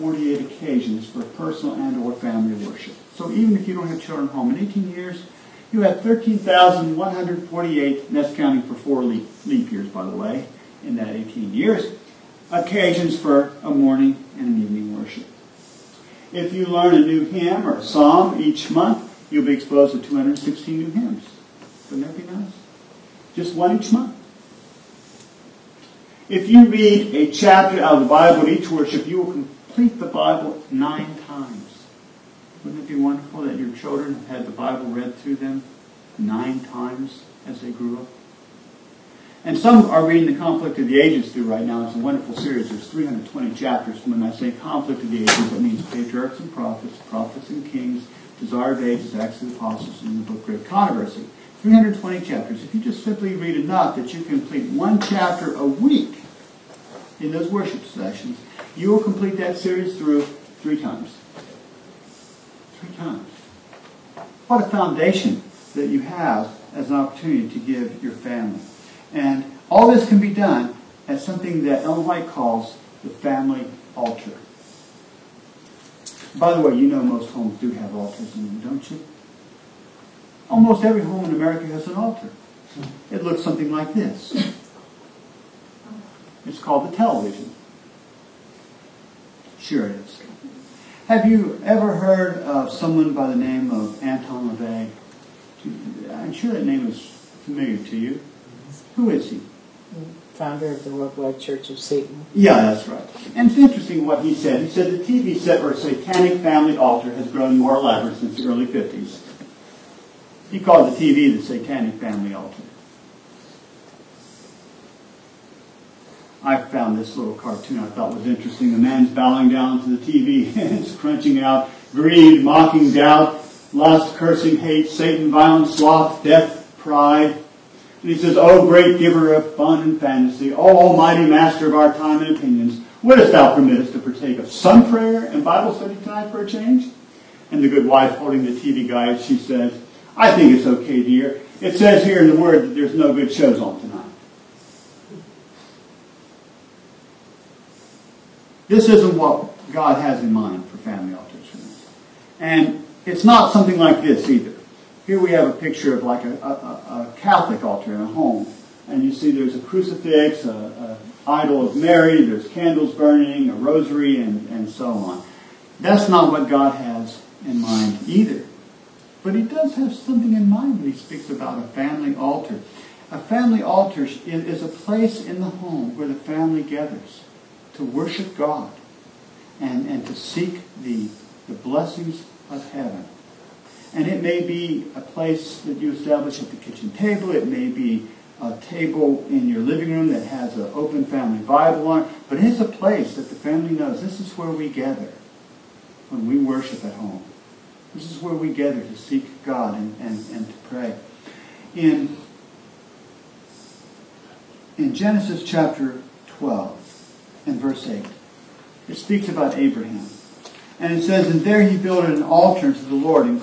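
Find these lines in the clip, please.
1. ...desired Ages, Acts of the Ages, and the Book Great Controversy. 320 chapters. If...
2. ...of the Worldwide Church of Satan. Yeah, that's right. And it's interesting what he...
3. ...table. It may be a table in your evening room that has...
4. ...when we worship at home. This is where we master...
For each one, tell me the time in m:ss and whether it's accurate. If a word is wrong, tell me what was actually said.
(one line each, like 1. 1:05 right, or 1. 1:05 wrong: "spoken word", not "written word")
1. 0:48 wrong: "Apostles", not "Ages"
2. 1:40 right
3. 3:06 wrong: "living", not "evening"
4. 3:16 wrong: "gather", not "master".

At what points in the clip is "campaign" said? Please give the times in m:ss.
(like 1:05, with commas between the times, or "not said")
not said.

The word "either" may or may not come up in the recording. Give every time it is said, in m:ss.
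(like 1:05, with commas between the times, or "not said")
2:34, 2:48.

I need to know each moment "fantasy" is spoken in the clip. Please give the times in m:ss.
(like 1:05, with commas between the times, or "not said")
2:09.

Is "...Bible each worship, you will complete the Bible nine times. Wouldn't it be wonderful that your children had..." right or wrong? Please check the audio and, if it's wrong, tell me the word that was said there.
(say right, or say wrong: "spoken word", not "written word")
right.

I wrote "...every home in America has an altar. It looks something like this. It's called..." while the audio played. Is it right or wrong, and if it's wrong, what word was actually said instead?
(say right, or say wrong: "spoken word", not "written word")
right.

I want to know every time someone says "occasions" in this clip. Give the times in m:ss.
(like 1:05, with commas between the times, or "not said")
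0:00, 0:12.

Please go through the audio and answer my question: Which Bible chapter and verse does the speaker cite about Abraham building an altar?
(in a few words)
Genesis 12:8.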